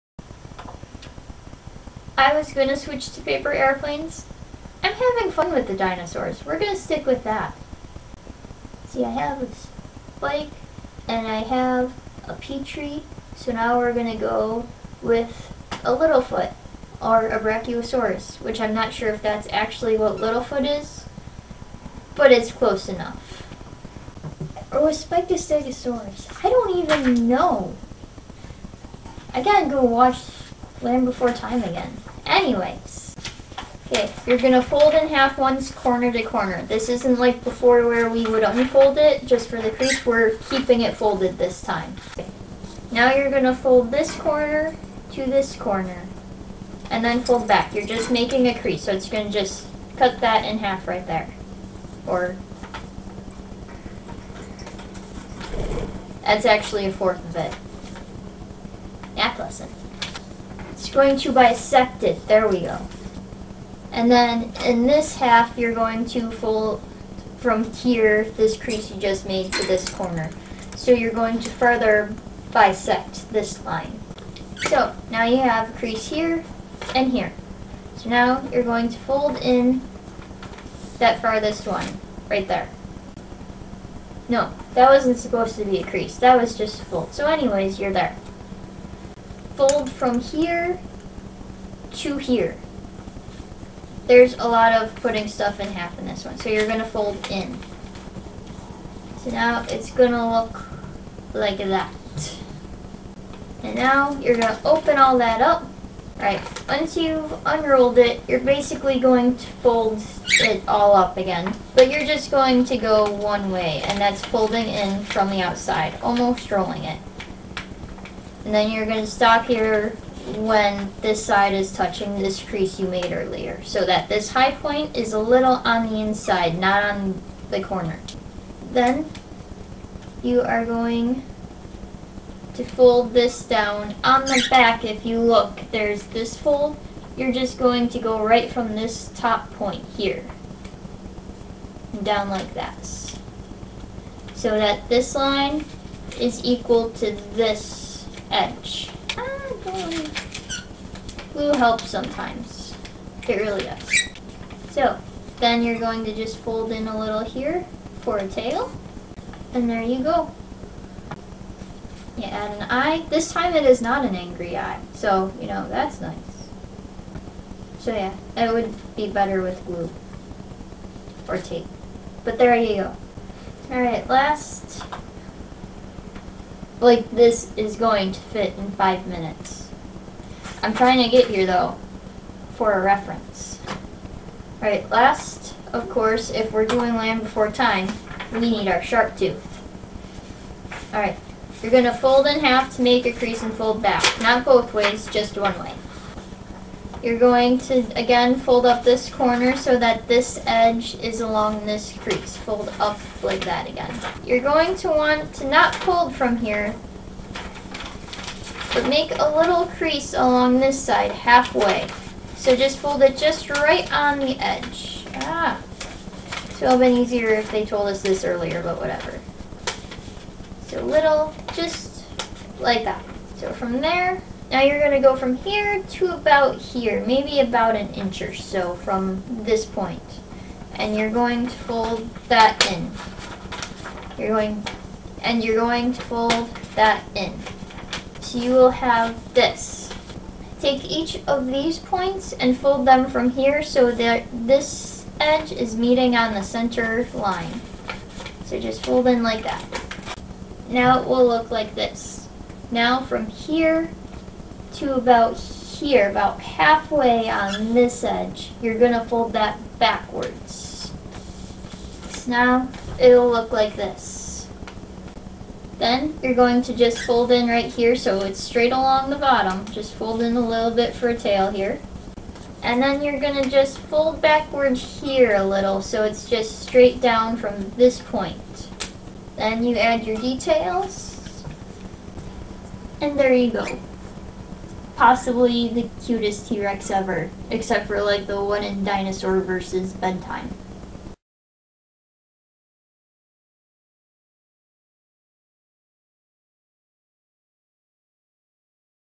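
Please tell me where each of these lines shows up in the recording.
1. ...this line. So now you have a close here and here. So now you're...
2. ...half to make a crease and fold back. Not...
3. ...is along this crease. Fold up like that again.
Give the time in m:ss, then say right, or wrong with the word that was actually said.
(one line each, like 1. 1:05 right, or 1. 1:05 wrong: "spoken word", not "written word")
1. 1:13 wrong: "crease", not "close"
2. 3:12 right
3. 3:20 right.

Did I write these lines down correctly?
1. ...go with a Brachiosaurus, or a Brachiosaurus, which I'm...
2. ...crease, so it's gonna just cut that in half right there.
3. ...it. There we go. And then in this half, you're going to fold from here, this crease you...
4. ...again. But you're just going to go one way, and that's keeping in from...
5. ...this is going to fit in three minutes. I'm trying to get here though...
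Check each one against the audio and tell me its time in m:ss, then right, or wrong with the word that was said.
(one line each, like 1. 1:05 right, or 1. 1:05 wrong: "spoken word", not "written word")
1. 0:14 wrong: "Littlefoot", not "Brachiosaurus"
2. 0:48 right
3. 1:02 right
4. 1:51 wrong: "folding", not "keeping"
5. 2:57 wrong: "five", not "three".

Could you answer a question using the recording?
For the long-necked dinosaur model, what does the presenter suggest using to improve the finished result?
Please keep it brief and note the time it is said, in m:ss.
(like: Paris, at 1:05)
Glue or tape, at 2:49.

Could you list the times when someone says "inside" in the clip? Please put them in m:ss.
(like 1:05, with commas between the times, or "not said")
2:05.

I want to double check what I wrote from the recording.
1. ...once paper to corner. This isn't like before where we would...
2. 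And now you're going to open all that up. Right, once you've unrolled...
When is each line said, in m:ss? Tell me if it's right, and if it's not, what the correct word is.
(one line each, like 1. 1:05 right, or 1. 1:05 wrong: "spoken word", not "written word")
1. 0:35 wrong: "corner", not "paper"
2. 1:43 right.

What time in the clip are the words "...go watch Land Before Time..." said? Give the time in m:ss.
0:29.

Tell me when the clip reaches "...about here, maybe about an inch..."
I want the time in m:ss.
3:46.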